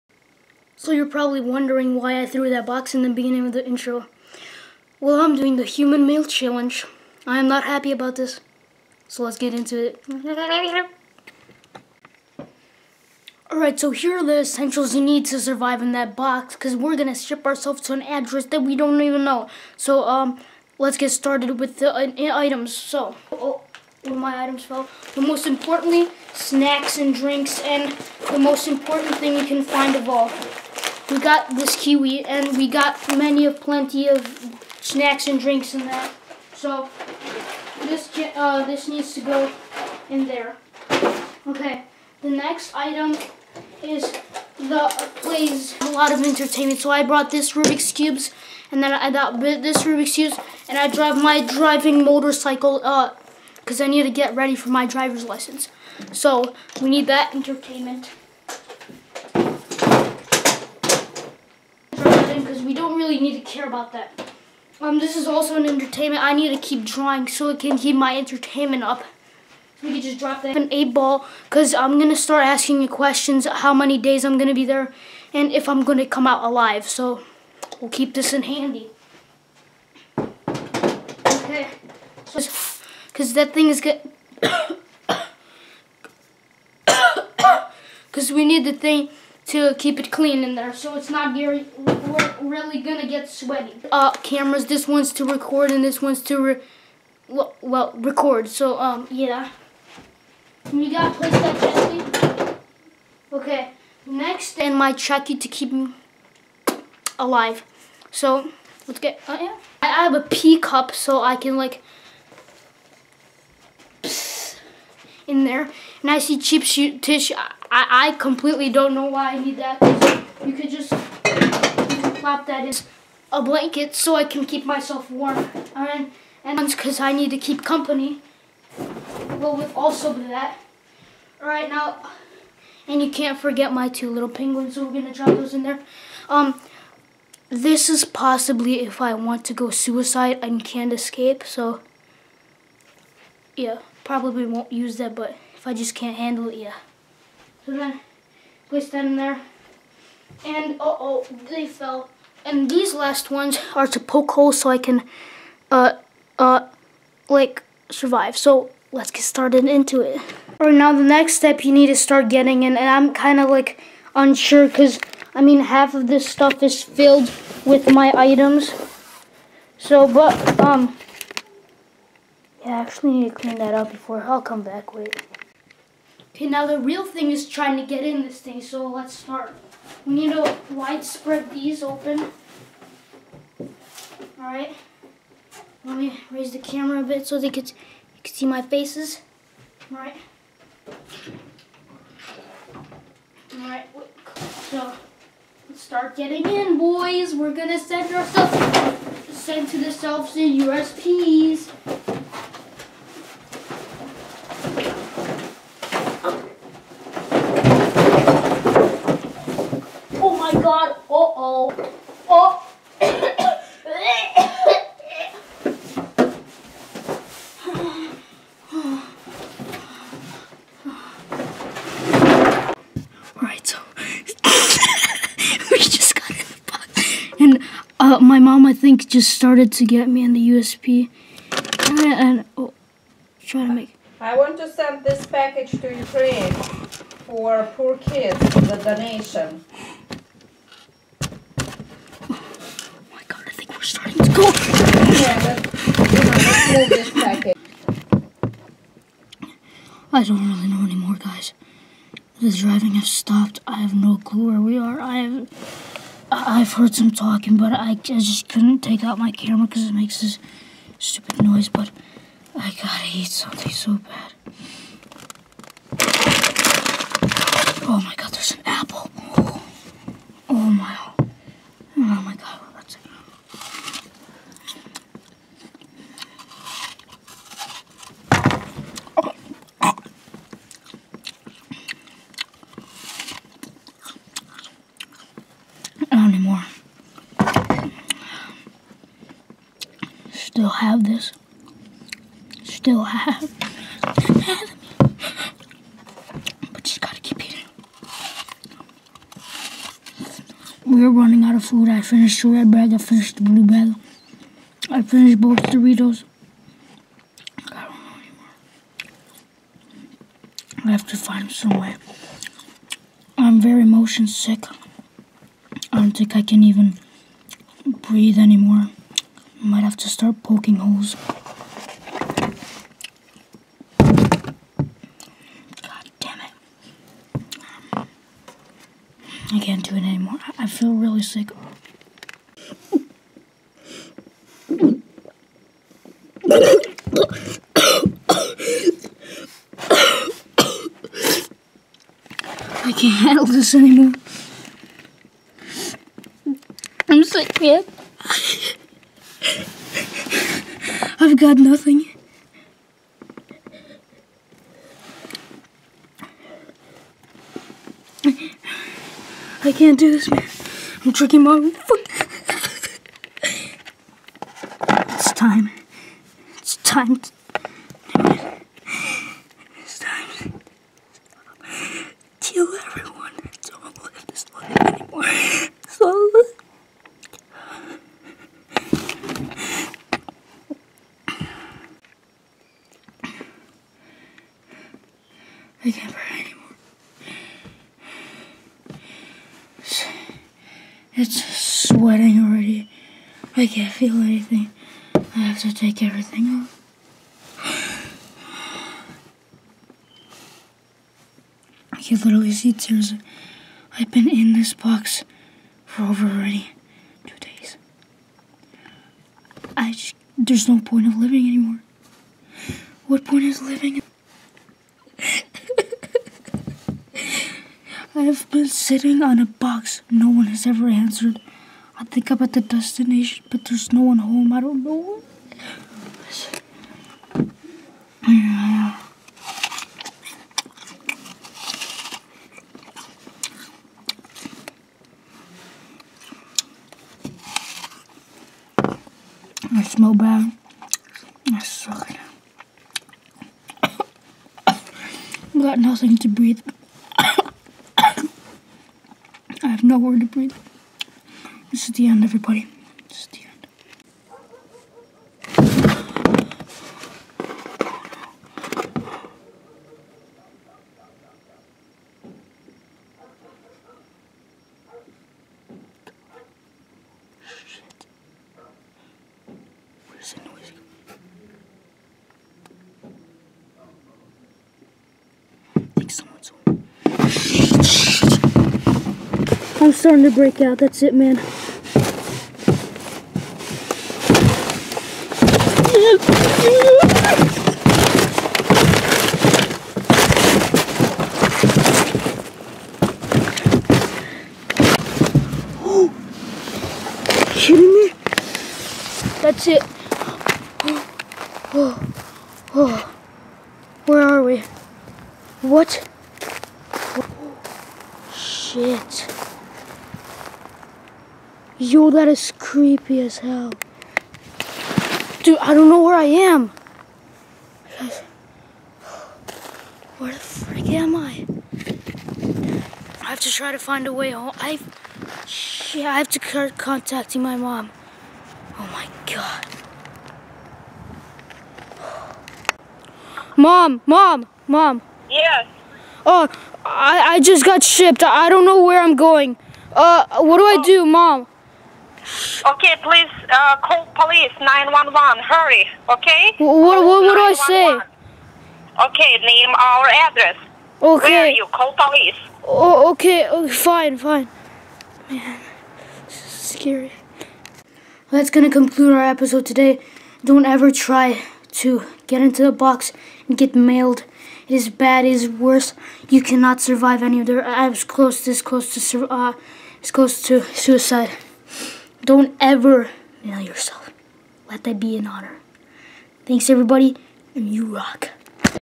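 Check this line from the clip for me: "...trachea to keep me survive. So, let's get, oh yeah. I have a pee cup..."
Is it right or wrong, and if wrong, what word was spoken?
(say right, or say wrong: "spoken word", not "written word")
wrong: "alive", not "survive".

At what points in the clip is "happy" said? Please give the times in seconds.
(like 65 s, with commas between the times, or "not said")
7 s.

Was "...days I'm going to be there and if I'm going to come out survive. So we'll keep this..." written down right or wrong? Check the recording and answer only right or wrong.
wrong.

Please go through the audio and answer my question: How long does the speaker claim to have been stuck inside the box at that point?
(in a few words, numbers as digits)
over 2 days.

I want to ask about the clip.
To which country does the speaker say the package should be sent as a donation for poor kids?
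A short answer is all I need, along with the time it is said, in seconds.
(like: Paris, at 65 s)
Ukraine, at 235 s.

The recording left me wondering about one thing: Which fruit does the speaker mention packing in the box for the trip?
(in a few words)
kiwi.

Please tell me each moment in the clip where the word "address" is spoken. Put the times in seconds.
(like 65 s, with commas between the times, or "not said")
18 s, 550 s.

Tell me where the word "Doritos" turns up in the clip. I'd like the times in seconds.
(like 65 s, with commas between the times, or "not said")
305 s.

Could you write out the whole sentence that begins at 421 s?
I think I'm at the destination, but there's no one home.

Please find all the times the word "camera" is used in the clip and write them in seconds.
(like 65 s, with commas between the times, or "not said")
94 s, 186 s, 259 s.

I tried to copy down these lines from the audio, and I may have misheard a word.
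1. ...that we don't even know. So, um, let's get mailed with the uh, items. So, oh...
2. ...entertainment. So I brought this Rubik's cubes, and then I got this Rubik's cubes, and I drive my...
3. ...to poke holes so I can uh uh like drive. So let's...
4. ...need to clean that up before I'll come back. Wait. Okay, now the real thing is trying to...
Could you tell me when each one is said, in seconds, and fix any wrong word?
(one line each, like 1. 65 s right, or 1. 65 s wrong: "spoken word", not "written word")
1. 18 s wrong: "started", not "mailed"
2. 46 s right
3. 153 s wrong: "survive", not "drive"
4. 173 s right.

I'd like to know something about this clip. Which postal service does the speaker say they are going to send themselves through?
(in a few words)
USPS.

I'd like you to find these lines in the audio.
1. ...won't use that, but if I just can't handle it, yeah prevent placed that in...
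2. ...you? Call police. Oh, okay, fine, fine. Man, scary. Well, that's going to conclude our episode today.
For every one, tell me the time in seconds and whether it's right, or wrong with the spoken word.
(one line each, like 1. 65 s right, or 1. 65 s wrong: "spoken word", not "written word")
1. 144 s right
2. 551 s right.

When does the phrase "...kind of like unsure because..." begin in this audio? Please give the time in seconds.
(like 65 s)
163 s.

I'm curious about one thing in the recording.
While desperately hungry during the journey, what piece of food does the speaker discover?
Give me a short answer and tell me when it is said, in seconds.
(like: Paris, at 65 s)
apple, at 268 s.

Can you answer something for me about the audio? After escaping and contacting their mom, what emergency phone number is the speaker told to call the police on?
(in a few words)
911.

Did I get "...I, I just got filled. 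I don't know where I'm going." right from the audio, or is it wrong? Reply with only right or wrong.
wrong.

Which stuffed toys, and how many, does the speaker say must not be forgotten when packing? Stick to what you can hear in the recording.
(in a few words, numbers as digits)
two little penguins.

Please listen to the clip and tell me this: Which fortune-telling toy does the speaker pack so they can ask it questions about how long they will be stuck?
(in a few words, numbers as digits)
eight ball.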